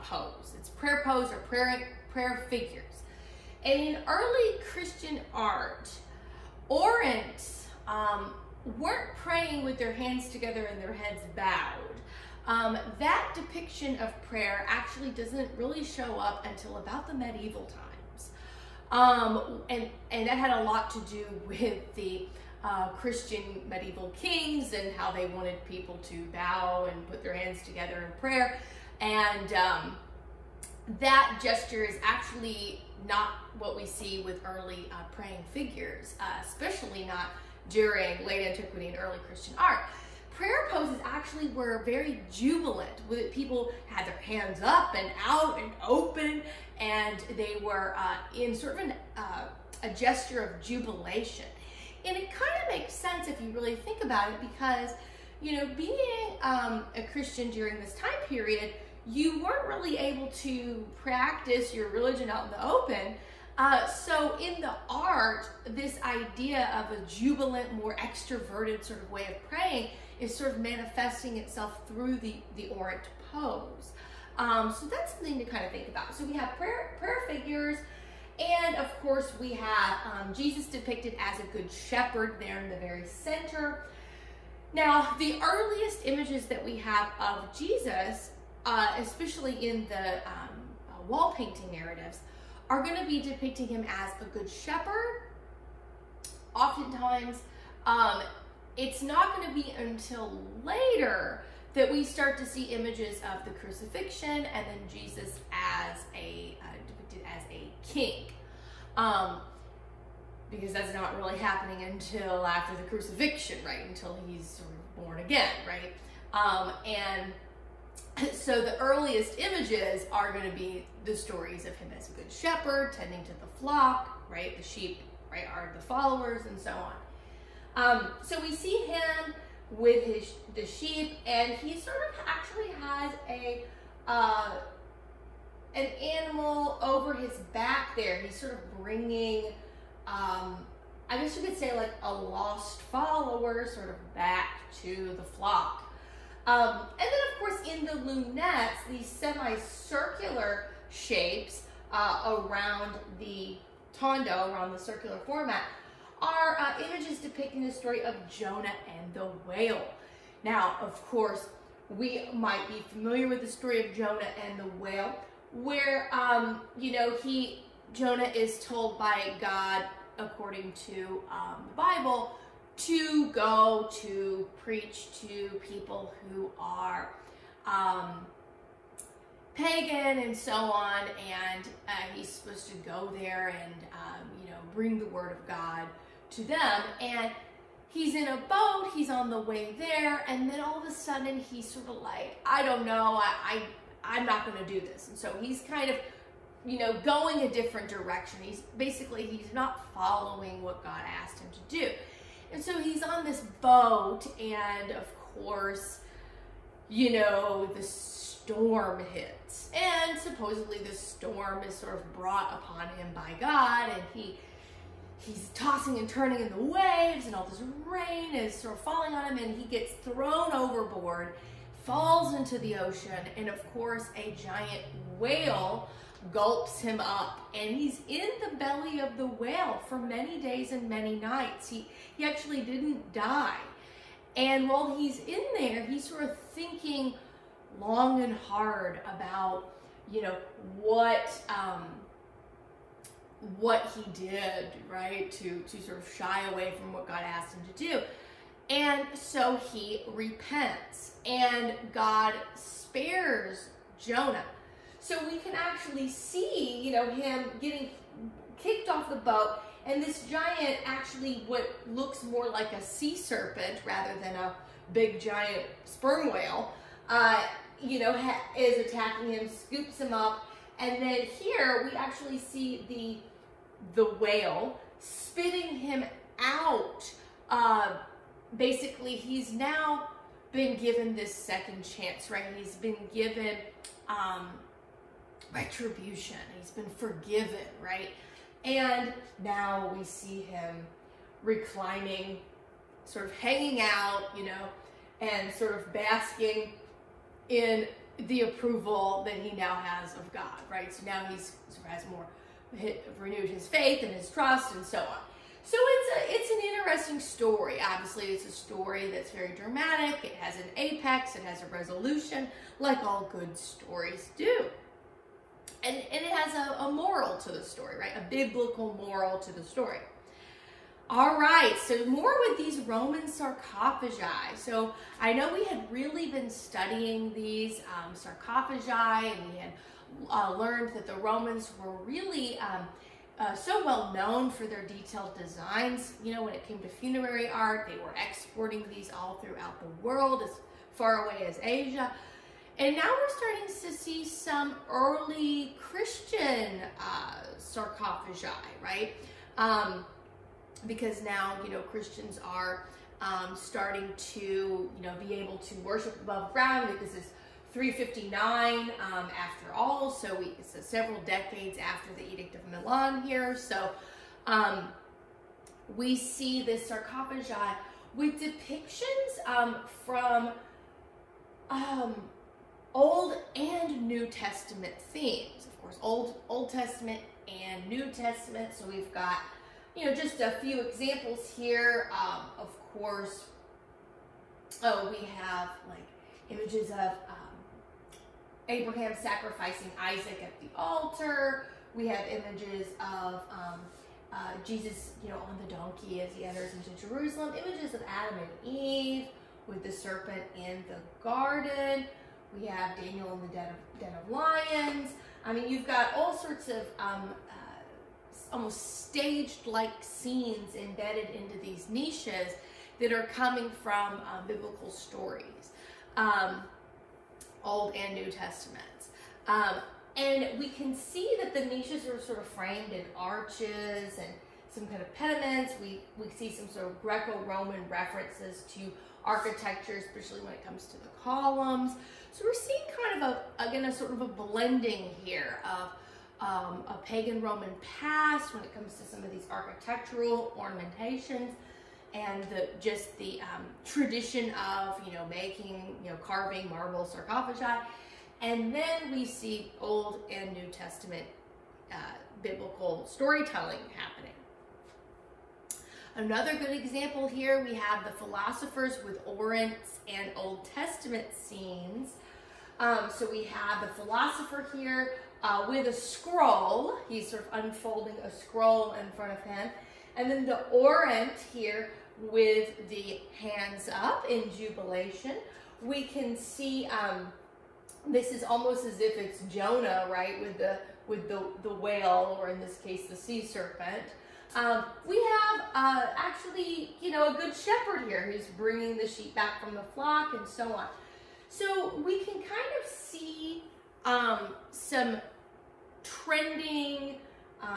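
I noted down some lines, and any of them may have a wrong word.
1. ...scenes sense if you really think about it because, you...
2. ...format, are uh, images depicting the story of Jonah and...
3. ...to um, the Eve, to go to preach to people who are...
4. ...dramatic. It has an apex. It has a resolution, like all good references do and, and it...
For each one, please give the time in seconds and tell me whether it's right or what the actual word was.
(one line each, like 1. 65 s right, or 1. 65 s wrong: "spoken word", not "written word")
1. 52 s wrong: "makes", not "scenes"
2. 155 s right
3. 170 s wrong: "Bible", not "Eve"
4. 309 s wrong: "stories", not "references".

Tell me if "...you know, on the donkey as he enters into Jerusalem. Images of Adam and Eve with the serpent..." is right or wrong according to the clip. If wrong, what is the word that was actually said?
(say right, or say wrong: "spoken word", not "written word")
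right.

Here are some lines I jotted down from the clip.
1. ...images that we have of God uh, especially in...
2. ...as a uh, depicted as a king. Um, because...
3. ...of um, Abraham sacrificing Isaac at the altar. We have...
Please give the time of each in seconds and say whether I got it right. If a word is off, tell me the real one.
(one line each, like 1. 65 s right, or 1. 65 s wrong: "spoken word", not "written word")
1. 86 s wrong: "Jesus", not "God"
2. 105 s right
3. 386 s right.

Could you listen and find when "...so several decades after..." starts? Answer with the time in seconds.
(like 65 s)
360 s.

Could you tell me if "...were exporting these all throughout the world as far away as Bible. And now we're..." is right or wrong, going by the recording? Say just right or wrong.
wrong.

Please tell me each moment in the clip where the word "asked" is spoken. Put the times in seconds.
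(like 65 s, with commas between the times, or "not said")
201 s, 247 s.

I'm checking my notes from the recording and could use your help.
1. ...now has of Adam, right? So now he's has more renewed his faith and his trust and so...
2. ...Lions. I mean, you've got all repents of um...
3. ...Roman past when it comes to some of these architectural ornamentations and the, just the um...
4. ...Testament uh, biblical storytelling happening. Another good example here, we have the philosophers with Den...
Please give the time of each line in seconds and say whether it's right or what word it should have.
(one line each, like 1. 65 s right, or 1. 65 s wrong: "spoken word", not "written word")
1. 299 s wrong: "God", not "Adam"
2. 404 s wrong: "sorts", not "repents"
3. 437 s right
4. 450 s wrong: "Orant", not "Den".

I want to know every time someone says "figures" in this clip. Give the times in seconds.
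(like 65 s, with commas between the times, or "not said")
2 s, 35 s, 77 s.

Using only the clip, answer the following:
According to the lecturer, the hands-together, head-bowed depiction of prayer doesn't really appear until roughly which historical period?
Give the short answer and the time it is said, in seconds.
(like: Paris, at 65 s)
medieval times, at 17 s.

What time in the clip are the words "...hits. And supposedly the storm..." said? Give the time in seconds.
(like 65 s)
209 s.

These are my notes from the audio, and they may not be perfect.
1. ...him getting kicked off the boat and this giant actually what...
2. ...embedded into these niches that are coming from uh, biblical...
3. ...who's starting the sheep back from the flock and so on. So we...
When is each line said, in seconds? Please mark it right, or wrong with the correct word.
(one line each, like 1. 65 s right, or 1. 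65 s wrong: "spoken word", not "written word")
1. 257 s right
2. 410 s right
3. 488 s wrong: "bringing", not "starting".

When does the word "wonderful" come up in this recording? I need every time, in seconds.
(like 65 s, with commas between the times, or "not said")
not said.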